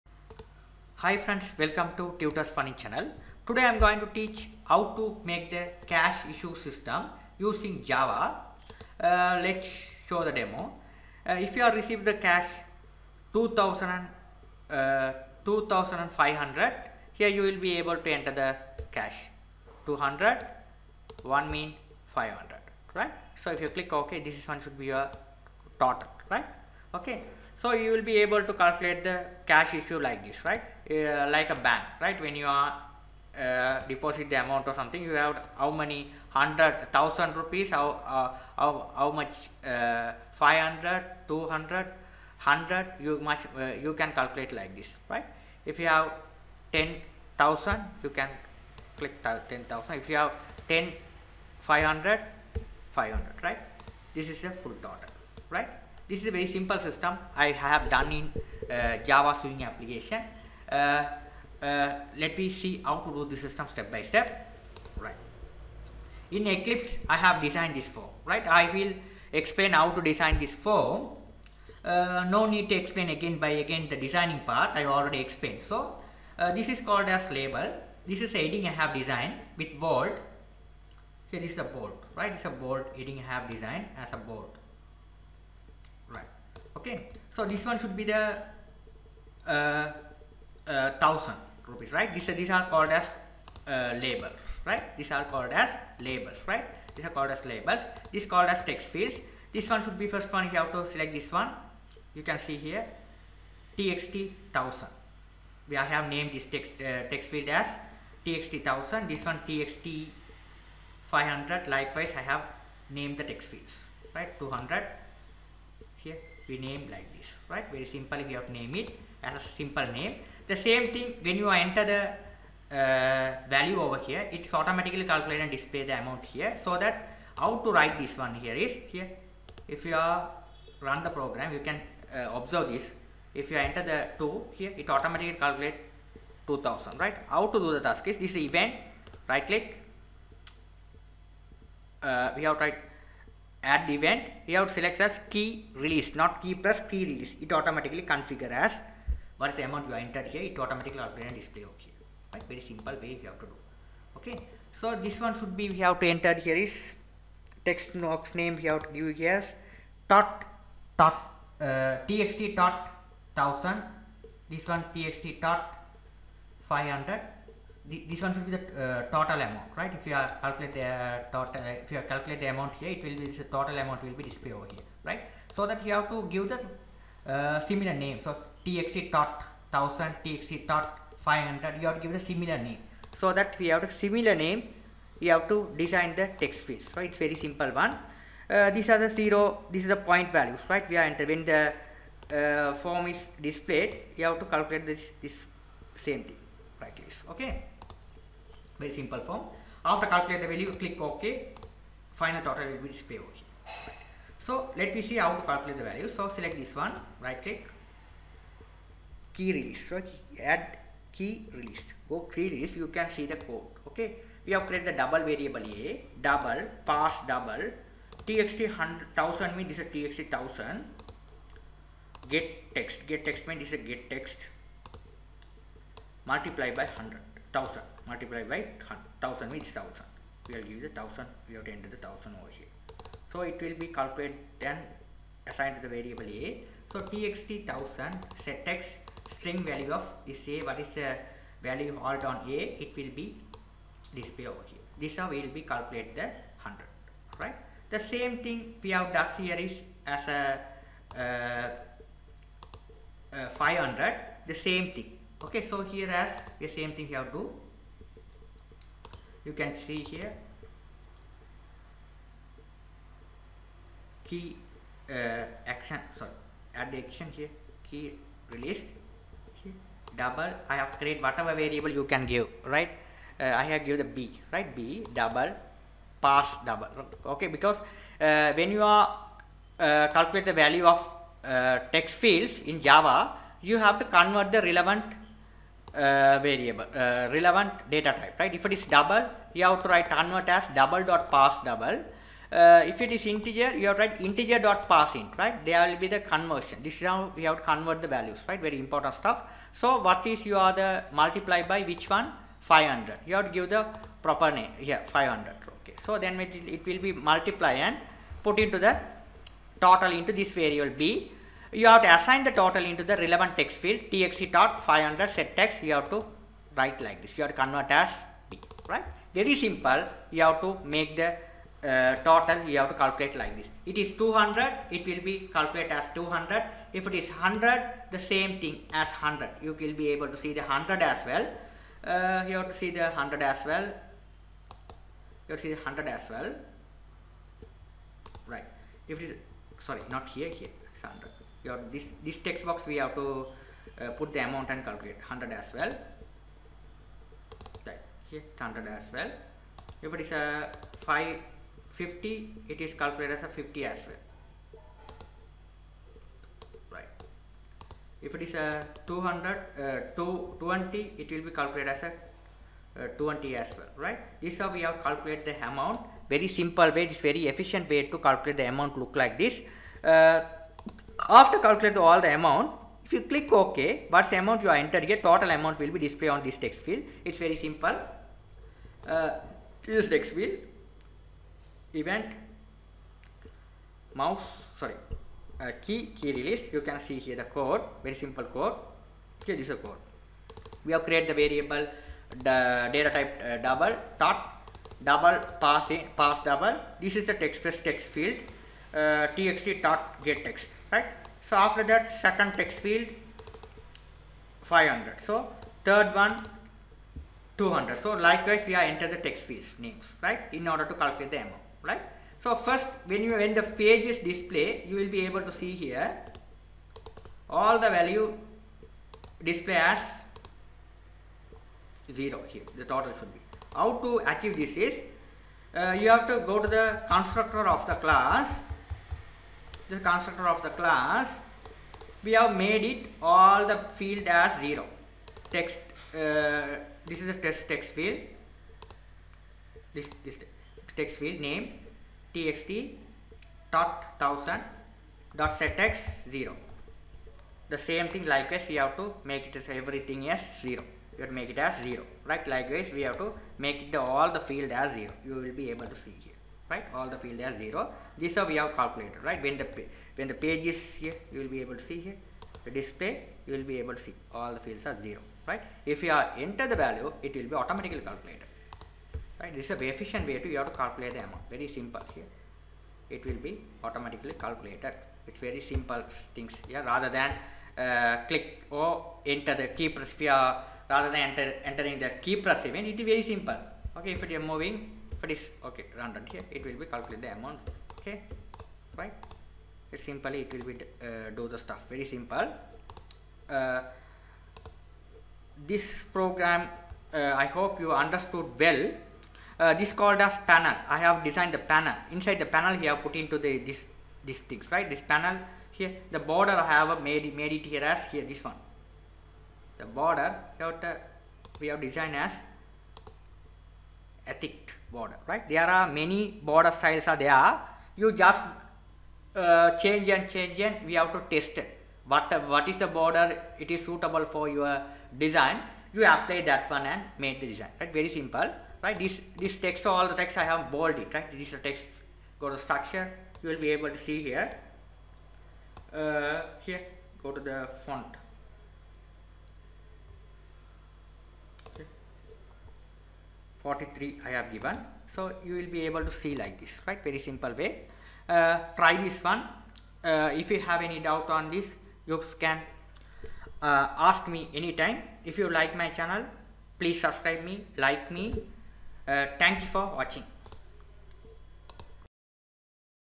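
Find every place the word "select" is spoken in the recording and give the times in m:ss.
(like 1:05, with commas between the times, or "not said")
1:40, 2:24, 3:26.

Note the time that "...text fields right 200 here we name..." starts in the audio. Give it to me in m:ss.
1:53.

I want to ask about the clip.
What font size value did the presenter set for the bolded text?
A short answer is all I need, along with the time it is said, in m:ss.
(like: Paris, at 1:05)
43, at 9:03.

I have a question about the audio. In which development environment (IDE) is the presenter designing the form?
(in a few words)
Eclipse.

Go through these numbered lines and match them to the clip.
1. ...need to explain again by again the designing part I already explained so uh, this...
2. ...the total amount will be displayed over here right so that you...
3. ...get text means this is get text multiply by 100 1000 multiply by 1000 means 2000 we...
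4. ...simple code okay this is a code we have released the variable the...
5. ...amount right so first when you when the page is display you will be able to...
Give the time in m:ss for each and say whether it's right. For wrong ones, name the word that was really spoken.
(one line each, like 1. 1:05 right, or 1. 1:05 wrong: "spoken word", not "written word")
1. 1:12 right
2. 2:53 right
3. 3:43 wrong: "1000", not "2000"
4. 6:28 wrong: "created", not "released"
5. 6:51 right.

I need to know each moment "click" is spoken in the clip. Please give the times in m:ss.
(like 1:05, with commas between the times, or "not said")
0:23, 0:48, 2:19, 3:20, 3:27, 6:13, 7:58.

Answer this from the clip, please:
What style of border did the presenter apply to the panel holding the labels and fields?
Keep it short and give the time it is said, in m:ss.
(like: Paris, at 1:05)
thick border, at 8:34.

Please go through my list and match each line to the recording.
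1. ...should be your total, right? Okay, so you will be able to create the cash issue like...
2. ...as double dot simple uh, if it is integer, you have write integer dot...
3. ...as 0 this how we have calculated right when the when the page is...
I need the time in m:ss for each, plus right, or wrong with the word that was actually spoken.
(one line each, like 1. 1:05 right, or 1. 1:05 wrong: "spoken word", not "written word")
1. 0:24 wrong: "calculate", not "create"
2. 4:50 wrong: "parseDouble", not "simple"
3. 7:37 right.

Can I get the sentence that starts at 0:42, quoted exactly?
You much uh, you can calculate like this, right?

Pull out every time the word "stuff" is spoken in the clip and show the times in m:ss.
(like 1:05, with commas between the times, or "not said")
4:59, 8:11.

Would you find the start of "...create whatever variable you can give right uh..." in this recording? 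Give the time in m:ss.
4:31.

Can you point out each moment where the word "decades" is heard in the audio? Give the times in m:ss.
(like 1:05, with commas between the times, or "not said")
not said.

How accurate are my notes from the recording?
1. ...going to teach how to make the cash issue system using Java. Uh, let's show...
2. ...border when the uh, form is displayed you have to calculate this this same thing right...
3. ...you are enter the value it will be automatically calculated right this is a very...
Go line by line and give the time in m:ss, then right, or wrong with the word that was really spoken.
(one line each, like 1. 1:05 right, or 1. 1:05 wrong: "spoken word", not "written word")
1. 0:03 right
2. 3:11 wrong: "enter", not "border"
3. 7:46 right.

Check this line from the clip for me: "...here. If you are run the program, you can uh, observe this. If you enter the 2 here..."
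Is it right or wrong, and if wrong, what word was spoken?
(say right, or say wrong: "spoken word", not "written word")
right.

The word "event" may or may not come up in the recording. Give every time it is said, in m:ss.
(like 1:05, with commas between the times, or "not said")
2:18, 2:23, 6:21, 8:02.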